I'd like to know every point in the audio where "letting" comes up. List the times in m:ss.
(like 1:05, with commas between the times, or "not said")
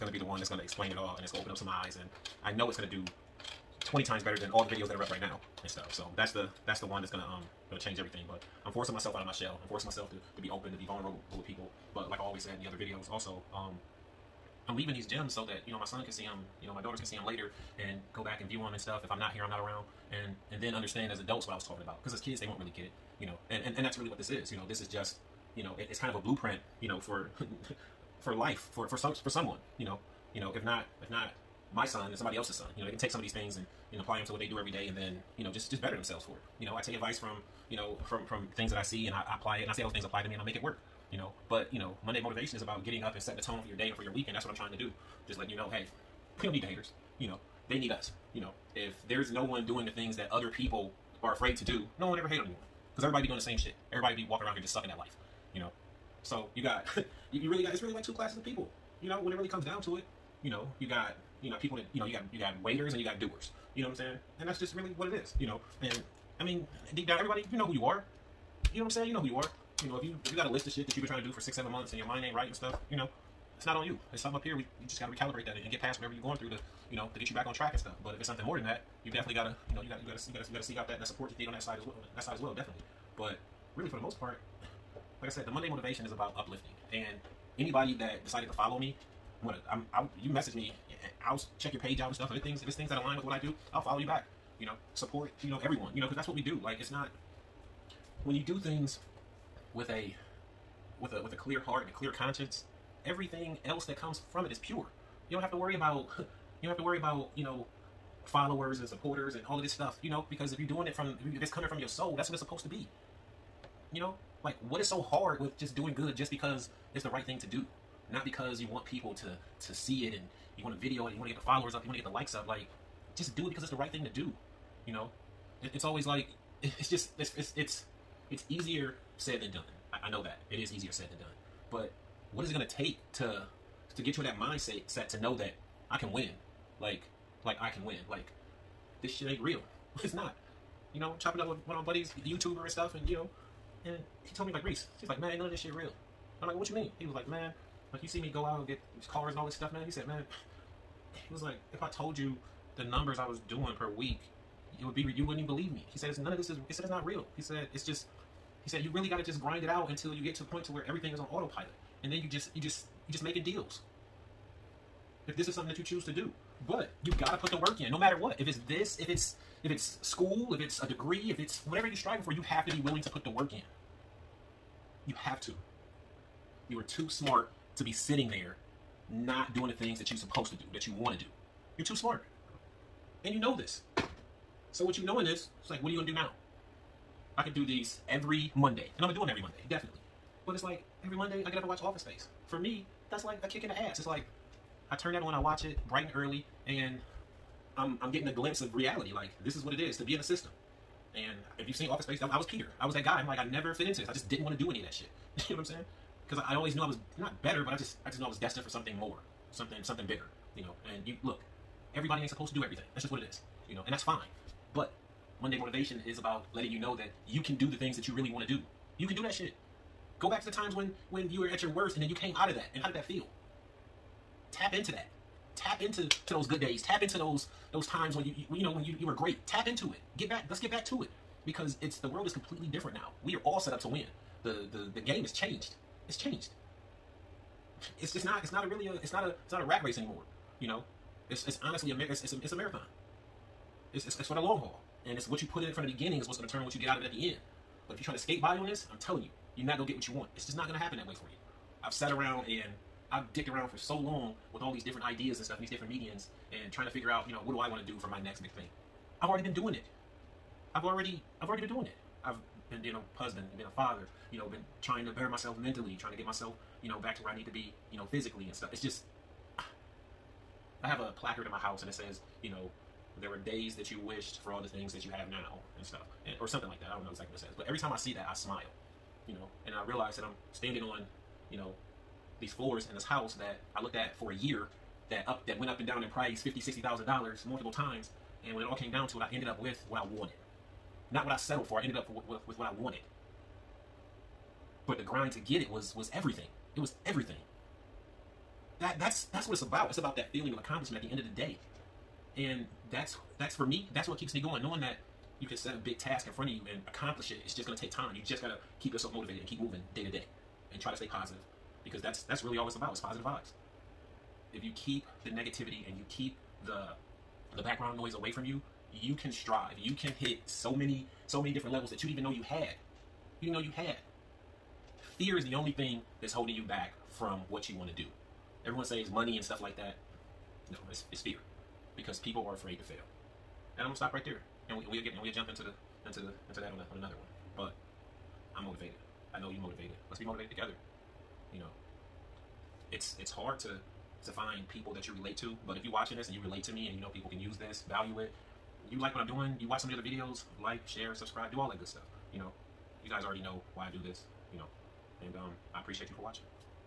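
0:45, 3:36.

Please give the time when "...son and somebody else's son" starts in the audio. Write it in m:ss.
0:31.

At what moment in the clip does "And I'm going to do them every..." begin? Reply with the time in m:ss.
3:08.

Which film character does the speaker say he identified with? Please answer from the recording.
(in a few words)
Peter.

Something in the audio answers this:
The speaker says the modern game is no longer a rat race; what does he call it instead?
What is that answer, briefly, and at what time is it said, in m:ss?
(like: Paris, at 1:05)
a marathon, at 4:02.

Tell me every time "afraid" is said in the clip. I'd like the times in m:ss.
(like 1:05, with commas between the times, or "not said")
0:51, 5:32.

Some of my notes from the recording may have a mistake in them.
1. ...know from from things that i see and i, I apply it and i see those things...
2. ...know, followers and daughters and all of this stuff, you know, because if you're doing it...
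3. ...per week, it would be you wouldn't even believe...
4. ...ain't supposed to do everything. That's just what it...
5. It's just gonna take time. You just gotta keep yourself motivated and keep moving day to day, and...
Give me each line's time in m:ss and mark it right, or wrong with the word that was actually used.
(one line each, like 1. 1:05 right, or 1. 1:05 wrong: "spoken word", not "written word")
1. 0:37 right
2. 1:47 wrong: "supporters", not "daughters"
3. 2:33 right
4. 3:32 right
5. 5:07 right.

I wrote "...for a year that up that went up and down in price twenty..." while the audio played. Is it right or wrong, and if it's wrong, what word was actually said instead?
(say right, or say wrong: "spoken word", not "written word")
wrong: "fifty", not "twenty".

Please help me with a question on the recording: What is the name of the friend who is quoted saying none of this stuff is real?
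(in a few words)
Reese.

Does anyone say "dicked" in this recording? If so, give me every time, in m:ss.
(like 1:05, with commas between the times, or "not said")
4:13.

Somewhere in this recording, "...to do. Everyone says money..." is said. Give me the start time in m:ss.
5:27.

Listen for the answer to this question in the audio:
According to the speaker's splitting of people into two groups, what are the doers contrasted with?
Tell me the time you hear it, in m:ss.
1:02.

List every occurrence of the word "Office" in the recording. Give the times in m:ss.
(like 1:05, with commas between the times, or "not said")
3:11, 3:21.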